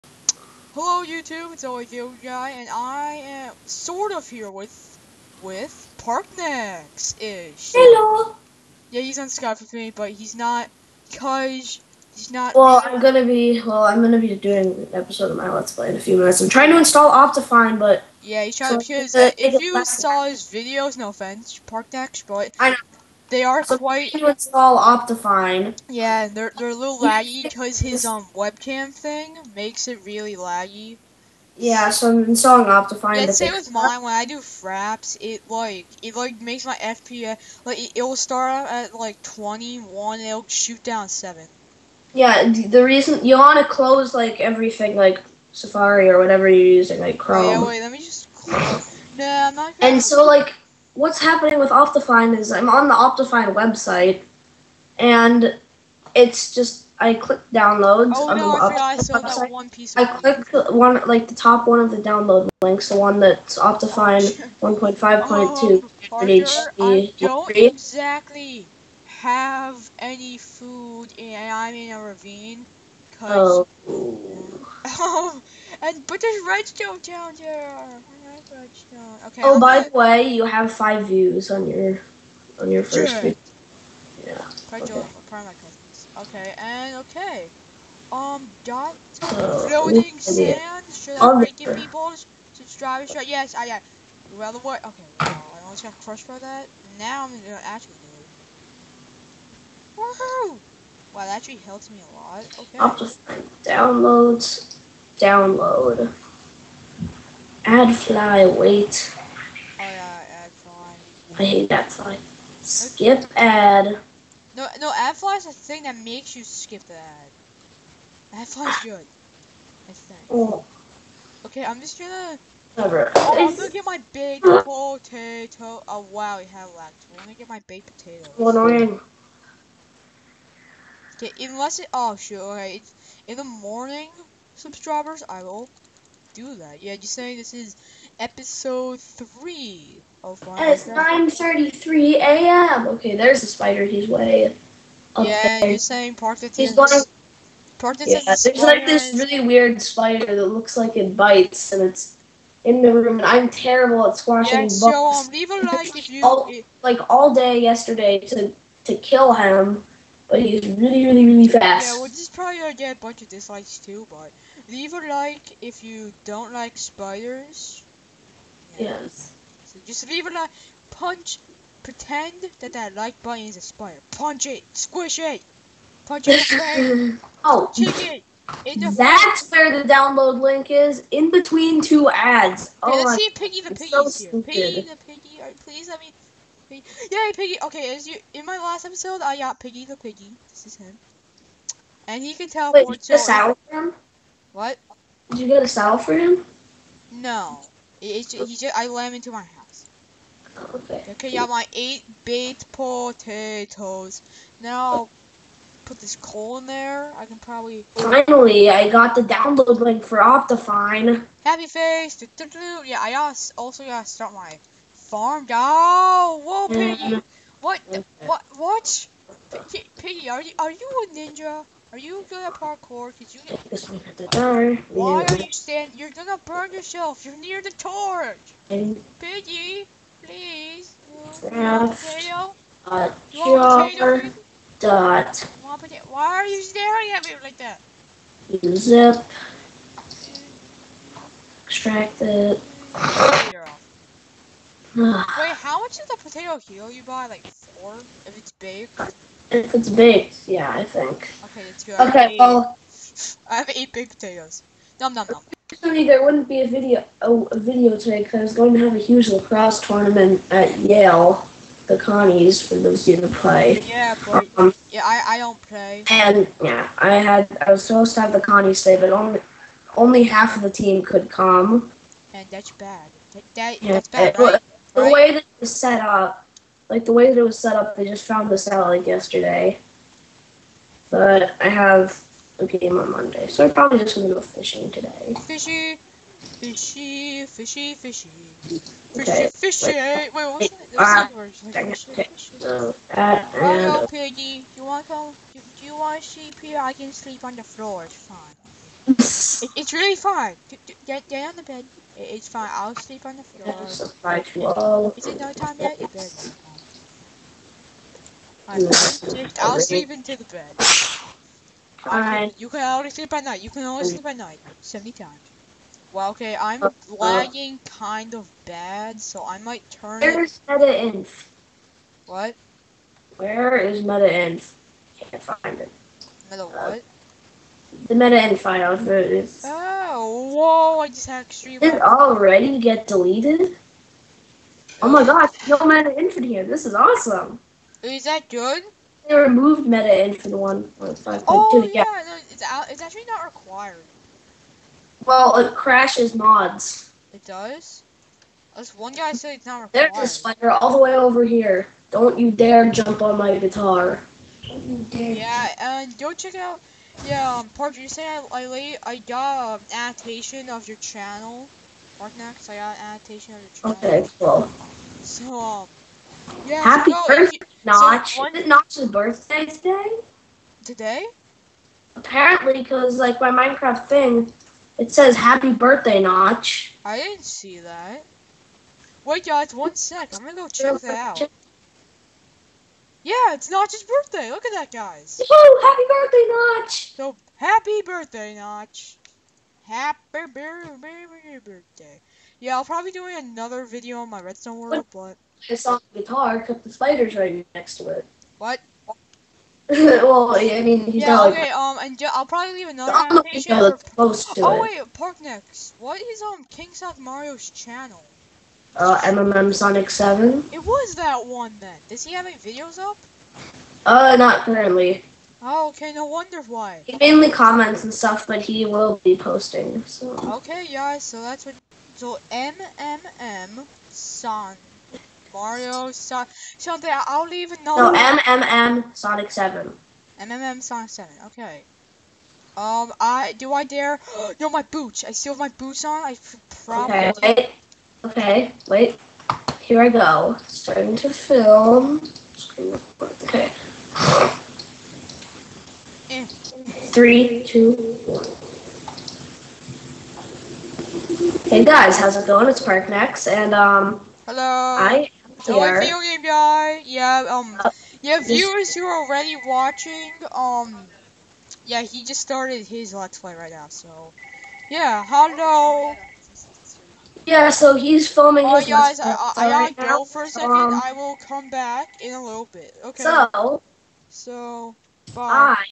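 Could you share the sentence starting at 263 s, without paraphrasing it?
Yeah, but um, yeah, I, I don't play.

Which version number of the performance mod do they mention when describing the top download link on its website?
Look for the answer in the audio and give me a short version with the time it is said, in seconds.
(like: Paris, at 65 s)
1.5.2, at 64 s.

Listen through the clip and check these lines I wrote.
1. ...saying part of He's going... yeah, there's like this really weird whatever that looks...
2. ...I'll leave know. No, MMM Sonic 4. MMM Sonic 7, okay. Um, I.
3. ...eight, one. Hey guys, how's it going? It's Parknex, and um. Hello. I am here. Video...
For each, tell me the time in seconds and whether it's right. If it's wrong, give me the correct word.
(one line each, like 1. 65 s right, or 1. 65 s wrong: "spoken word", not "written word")
1. 145 s wrong: "spider", not "whatever"
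2. 427 s wrong: "7", not "4"
3. 447 s wrong: "two", not "eight".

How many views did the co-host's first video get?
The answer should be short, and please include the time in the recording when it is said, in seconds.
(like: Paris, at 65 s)
5, at 80 s.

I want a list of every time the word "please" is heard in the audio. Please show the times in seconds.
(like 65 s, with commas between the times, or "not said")
185 s, 230 s.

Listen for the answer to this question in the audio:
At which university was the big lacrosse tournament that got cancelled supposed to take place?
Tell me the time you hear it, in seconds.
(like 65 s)
260 s.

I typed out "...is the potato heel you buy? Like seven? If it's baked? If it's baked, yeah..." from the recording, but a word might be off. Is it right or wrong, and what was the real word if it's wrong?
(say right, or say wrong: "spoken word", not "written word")
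wrong: "four", not "seven".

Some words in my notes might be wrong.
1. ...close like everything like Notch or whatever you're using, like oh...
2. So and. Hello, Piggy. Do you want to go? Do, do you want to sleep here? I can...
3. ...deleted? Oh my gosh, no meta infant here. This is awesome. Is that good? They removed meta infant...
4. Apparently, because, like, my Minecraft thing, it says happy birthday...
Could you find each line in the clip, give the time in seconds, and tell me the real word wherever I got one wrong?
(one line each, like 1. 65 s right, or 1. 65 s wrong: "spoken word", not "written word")
1. 43 s wrong: "Safari", not "Notch"
2. 292 s right
3. 333 s right
4. 372 s right.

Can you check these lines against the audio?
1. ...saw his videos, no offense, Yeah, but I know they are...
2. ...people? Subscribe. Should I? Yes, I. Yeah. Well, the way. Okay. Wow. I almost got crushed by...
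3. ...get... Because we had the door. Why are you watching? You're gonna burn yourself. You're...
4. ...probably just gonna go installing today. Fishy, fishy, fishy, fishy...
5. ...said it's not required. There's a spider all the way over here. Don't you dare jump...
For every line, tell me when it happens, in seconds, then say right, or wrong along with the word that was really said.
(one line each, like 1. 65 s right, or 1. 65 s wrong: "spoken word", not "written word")
1. 19 s wrong: "Parknex", not "Yeah"
2. 91 s right
3. 223 s wrong: "standing", not "watching"
4. 283 s wrong: "fishing", not "installing"
5. 349 s right.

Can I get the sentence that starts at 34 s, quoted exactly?
When I do fraps, it like it like makes my FPS like it, will start at like 21.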